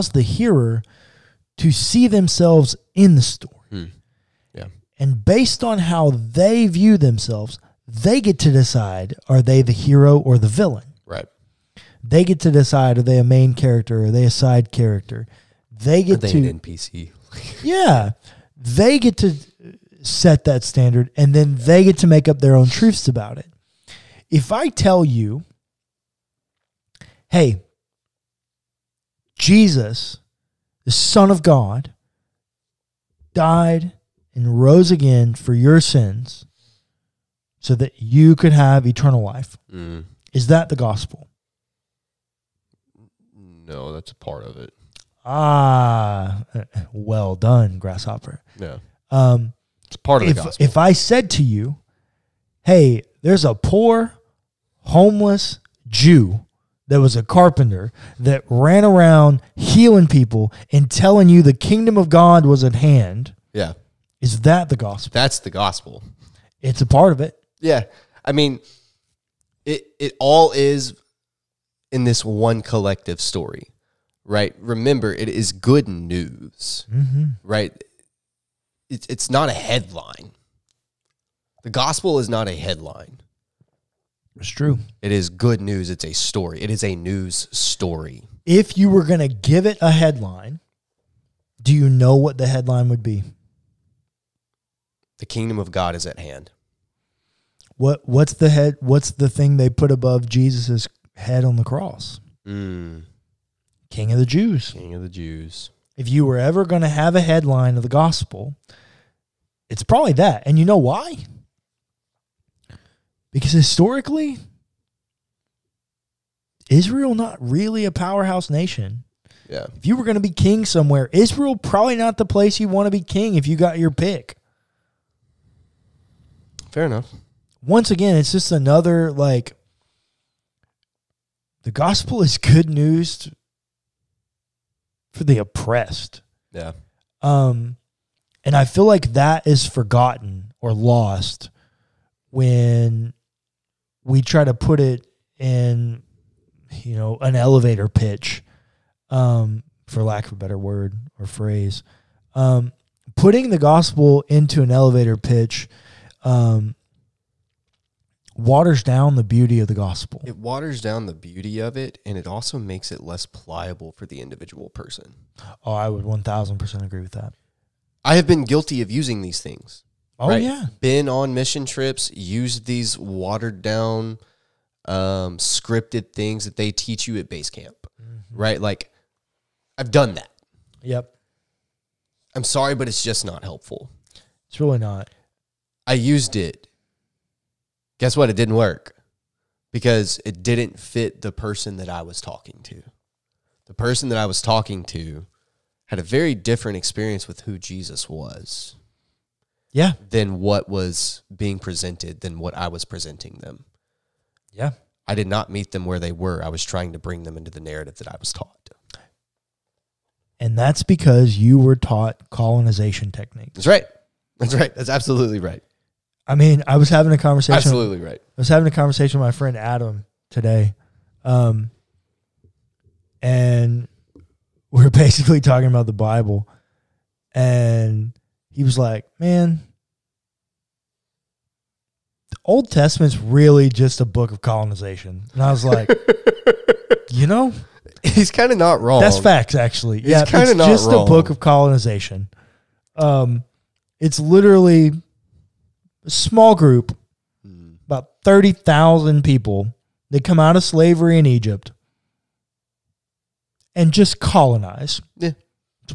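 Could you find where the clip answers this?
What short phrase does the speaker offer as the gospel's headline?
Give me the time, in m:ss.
1:35.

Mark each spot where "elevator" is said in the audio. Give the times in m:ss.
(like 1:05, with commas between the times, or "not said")
2:27, 2:34.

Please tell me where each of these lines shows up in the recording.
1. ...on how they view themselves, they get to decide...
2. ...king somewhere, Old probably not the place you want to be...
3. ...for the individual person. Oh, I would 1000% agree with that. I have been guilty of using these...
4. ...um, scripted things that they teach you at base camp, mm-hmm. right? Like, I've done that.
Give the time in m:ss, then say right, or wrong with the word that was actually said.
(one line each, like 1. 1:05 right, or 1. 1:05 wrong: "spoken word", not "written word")
1. 0:05 right
2. 2:00 wrong: "Israel", not "Old"
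3. 2:43 right
4. 2:54 right.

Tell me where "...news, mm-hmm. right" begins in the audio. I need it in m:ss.
1:15.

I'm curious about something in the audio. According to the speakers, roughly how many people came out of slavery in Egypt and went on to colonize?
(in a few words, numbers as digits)
30,000.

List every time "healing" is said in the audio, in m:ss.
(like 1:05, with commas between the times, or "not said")
0:59.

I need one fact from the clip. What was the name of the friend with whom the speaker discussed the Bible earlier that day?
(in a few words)
Adam.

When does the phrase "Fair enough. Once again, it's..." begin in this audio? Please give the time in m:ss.
2:06.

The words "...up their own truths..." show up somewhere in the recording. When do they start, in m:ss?
0:22.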